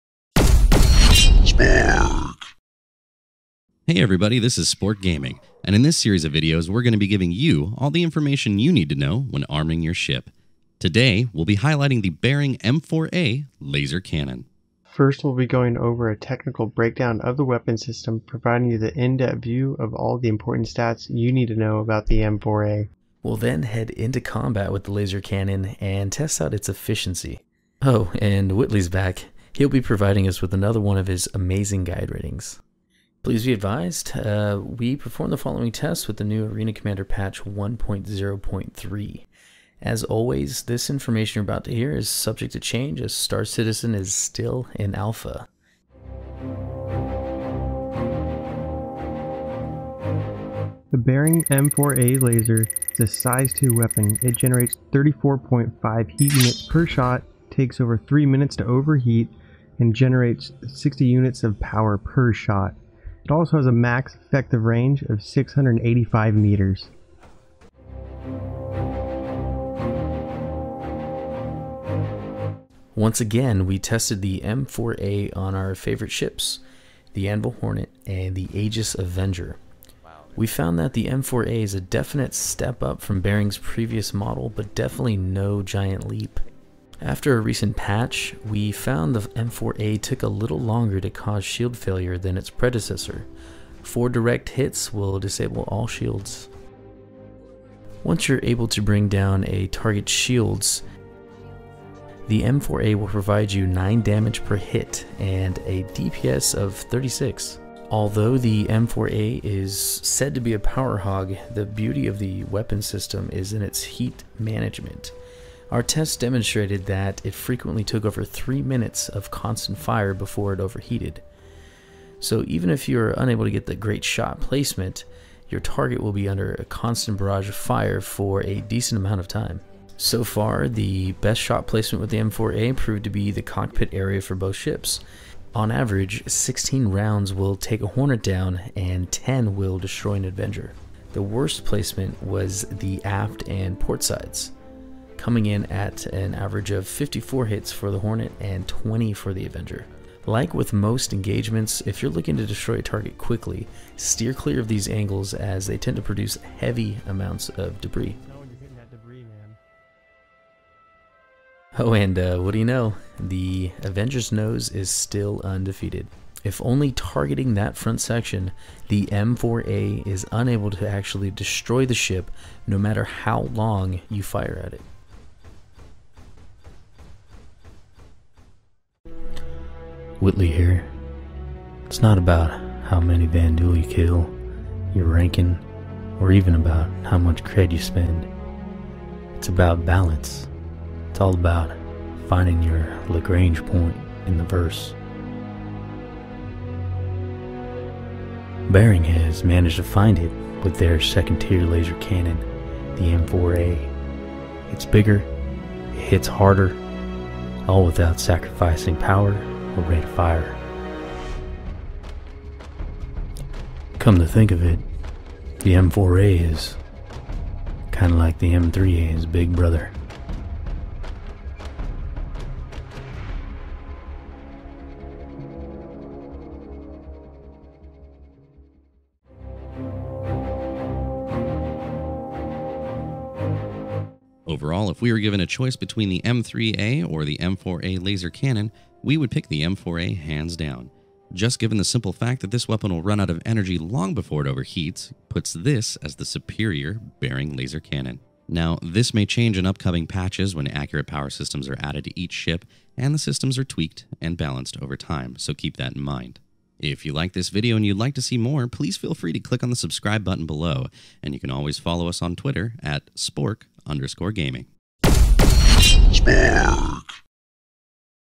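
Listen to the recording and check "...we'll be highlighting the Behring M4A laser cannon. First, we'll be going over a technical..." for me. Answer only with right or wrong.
right.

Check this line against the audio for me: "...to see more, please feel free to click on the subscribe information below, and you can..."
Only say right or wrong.
wrong.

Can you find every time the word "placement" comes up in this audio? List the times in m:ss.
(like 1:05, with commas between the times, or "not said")
2:04, 2:11, 2:21.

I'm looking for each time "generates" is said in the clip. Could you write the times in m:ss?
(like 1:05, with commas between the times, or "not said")
0:54, 0:59.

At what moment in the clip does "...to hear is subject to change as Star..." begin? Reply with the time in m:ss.
0:41.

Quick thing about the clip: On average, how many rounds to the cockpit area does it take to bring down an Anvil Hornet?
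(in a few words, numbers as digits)
16.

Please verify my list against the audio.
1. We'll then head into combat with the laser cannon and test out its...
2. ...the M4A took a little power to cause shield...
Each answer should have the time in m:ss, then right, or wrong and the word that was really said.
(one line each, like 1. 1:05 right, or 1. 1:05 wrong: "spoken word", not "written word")
1. 0:23 right
2. 1:29 wrong: "longer", not "power".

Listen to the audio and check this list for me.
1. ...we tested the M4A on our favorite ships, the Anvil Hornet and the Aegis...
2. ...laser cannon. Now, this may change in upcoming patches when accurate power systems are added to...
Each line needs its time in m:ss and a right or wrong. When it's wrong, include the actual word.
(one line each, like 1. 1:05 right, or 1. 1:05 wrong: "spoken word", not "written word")
1. 1:13 right
2. 4:07 right.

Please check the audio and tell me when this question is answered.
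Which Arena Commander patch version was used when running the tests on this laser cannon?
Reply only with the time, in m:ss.
0:37.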